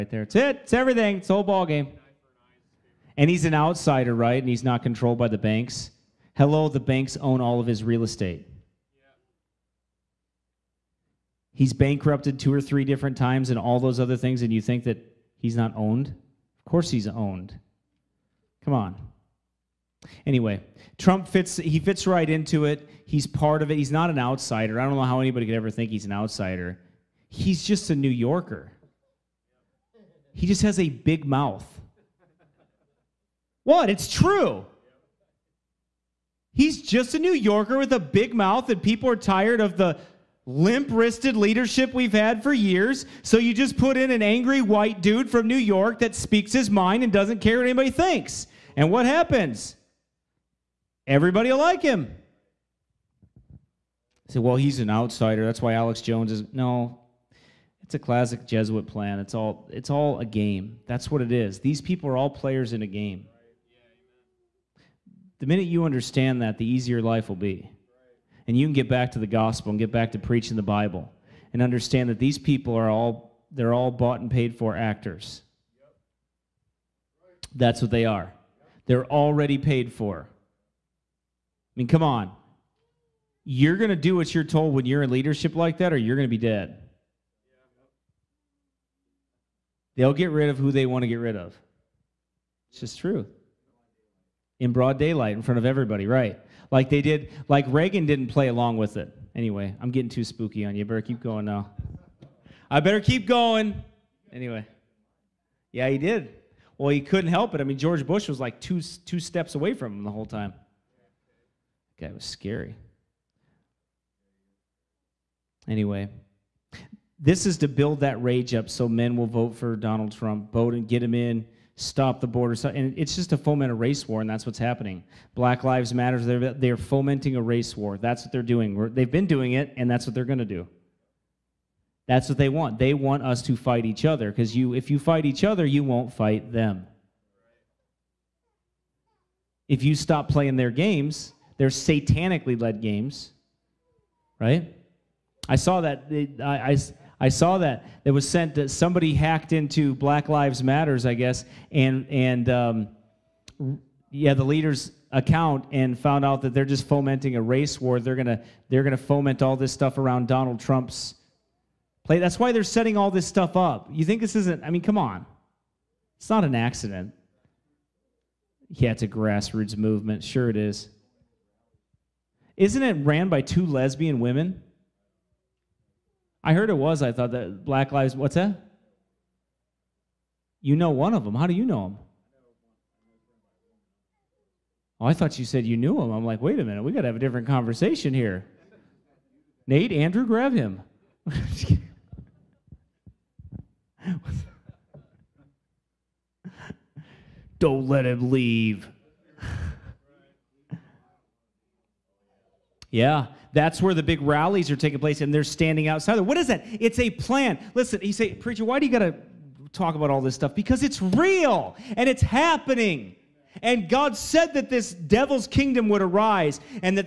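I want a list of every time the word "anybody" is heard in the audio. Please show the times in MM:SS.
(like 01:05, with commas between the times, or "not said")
00:25, 00:47.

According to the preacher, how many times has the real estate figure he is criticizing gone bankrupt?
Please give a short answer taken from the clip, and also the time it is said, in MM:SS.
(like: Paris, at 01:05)
2 or 3, at 00:12.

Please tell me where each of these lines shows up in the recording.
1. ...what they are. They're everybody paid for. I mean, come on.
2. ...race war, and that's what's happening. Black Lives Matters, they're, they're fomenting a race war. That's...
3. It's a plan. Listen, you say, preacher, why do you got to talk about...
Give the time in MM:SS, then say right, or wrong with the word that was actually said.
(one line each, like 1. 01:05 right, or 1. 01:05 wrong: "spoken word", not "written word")
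1. 01:17 wrong: "already", not "everybody"
2. 02:03 right
3. 03:26 right.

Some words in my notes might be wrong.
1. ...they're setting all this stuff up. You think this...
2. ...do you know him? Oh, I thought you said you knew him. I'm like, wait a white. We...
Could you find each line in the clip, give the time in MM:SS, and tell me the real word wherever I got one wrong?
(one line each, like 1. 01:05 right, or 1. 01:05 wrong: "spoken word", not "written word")
1. 02:42 right
2. 03:01 wrong: "minute", not "white".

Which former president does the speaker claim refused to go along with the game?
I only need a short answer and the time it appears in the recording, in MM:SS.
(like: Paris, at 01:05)
Reagan, at 01:37.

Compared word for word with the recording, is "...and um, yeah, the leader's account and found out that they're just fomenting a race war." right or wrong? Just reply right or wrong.
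right.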